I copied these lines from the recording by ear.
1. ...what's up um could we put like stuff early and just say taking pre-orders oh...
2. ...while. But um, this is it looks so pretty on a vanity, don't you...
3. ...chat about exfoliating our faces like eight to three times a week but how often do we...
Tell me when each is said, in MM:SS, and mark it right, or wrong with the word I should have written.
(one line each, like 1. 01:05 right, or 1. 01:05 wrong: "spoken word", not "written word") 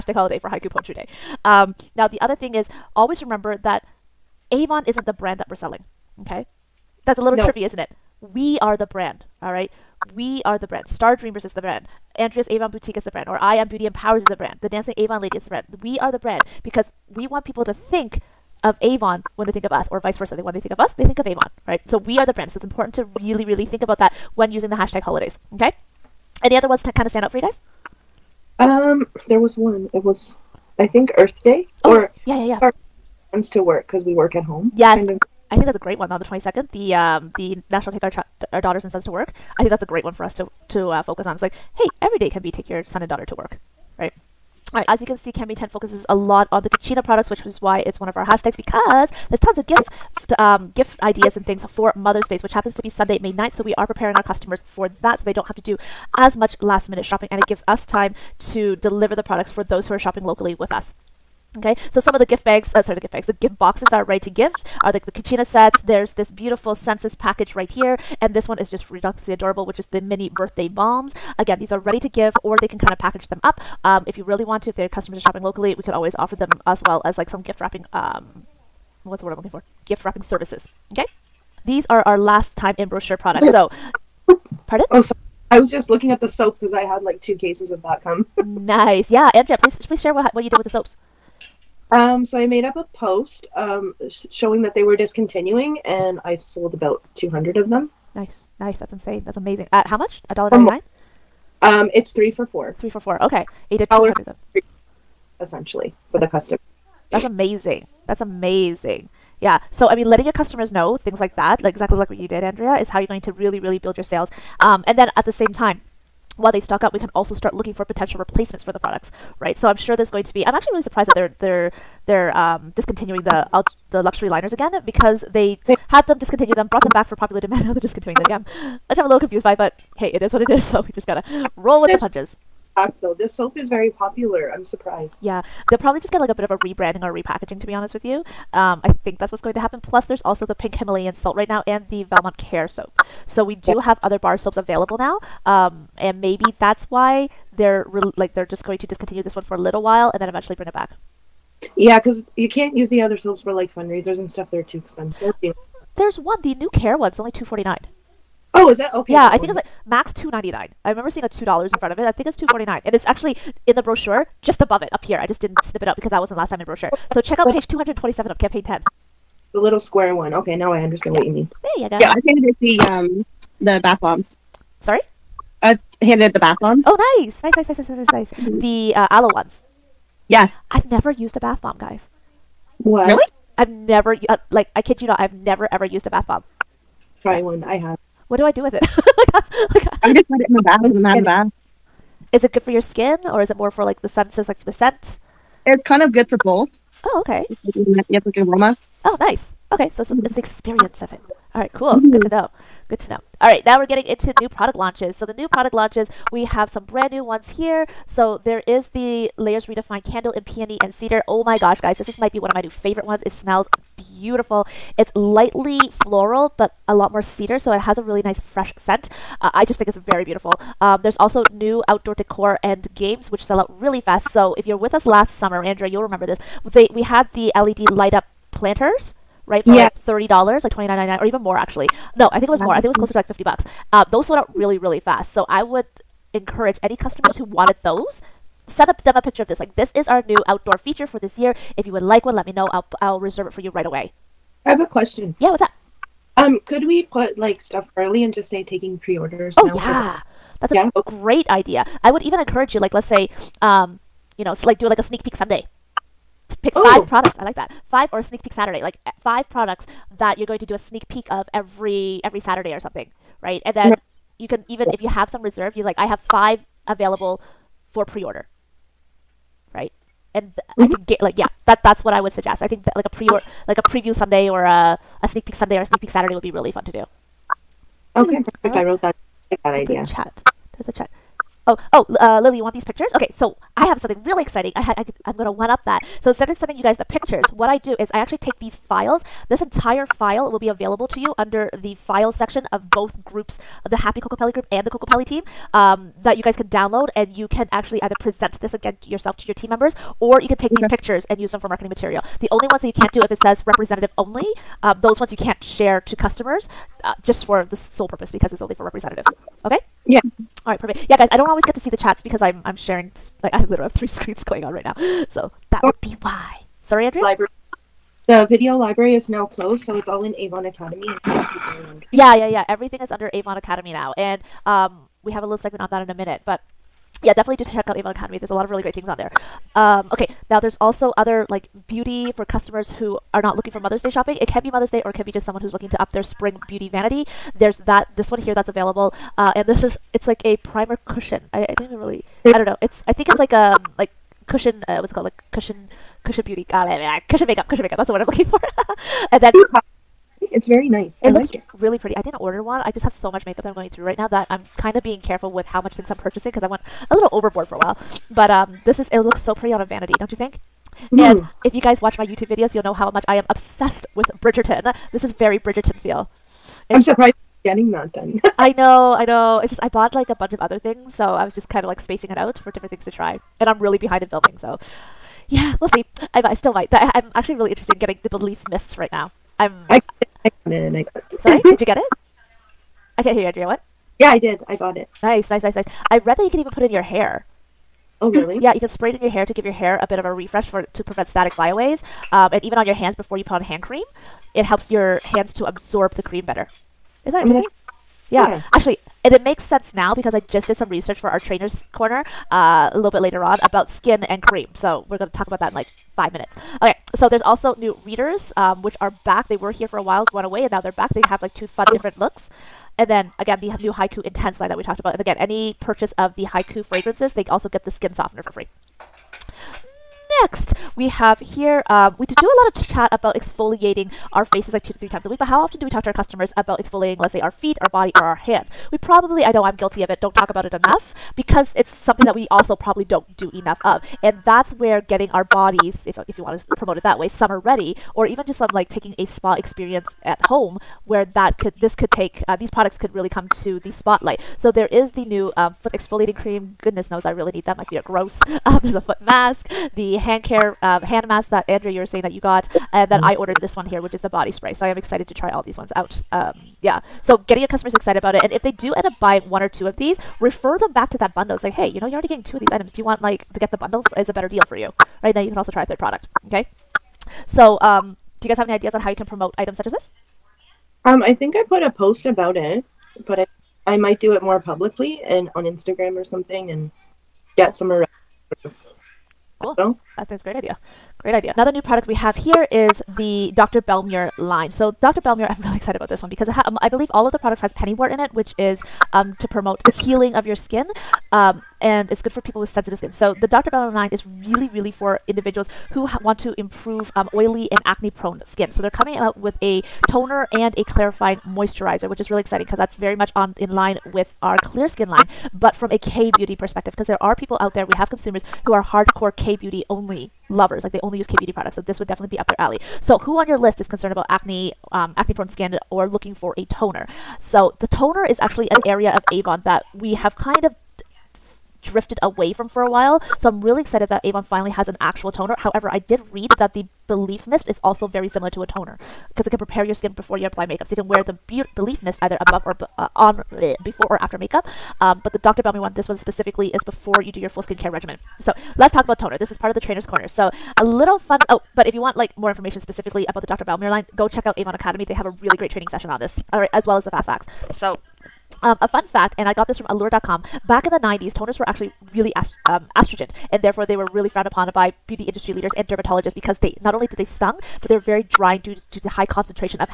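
1. 04:05 right
2. 05:57 right
3. 07:02 wrong: "two", not "eight".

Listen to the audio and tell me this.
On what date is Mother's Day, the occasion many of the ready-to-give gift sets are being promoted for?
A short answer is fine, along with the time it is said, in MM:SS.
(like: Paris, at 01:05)
Sunday, May 9th, at 00:52.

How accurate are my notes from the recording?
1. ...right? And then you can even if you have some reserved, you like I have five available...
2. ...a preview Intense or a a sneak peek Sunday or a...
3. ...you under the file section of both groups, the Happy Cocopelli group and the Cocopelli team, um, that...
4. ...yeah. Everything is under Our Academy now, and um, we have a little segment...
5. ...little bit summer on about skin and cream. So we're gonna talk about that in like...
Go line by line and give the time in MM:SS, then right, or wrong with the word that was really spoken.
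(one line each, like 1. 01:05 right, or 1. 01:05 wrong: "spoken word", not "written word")
1. 04:23 right
2. 04:33 wrong: "Sunday", not "Intense"
3. 04:51 right
4. 05:22 wrong: "Avon", not "Our"
5. 06:42 wrong: "later", not "summer".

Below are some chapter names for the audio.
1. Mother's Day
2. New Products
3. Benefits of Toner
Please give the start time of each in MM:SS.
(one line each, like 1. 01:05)
1. 00:42
2. 03:22
3. 08:01.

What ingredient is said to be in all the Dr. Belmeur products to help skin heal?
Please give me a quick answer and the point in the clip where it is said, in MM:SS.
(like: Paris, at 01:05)
Pennywort, at 08:07.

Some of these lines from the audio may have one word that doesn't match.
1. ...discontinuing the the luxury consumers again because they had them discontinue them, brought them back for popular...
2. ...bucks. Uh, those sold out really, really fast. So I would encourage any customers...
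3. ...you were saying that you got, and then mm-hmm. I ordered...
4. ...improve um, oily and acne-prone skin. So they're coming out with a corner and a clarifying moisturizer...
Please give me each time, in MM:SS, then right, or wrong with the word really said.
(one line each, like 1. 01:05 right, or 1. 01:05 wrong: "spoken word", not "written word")
1. 02:02 wrong: "liners", not "consumers"
2. 03:53 right
3. 07:31 right
4. 08:16 wrong: "toner", not "corner".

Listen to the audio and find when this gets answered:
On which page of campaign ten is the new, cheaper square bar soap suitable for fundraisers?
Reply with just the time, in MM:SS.
02:47.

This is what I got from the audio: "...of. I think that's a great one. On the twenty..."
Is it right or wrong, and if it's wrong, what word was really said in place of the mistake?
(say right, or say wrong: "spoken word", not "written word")
right.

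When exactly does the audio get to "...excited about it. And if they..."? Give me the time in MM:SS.
07:37.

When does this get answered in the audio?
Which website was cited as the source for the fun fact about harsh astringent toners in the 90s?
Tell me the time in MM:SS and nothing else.
09:09.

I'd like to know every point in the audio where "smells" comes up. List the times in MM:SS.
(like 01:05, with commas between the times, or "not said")
03:33.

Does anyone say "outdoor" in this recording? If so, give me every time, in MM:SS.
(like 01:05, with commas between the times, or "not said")
03:41, 04:00.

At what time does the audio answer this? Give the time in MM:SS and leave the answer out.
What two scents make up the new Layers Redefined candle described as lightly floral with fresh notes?
03:30.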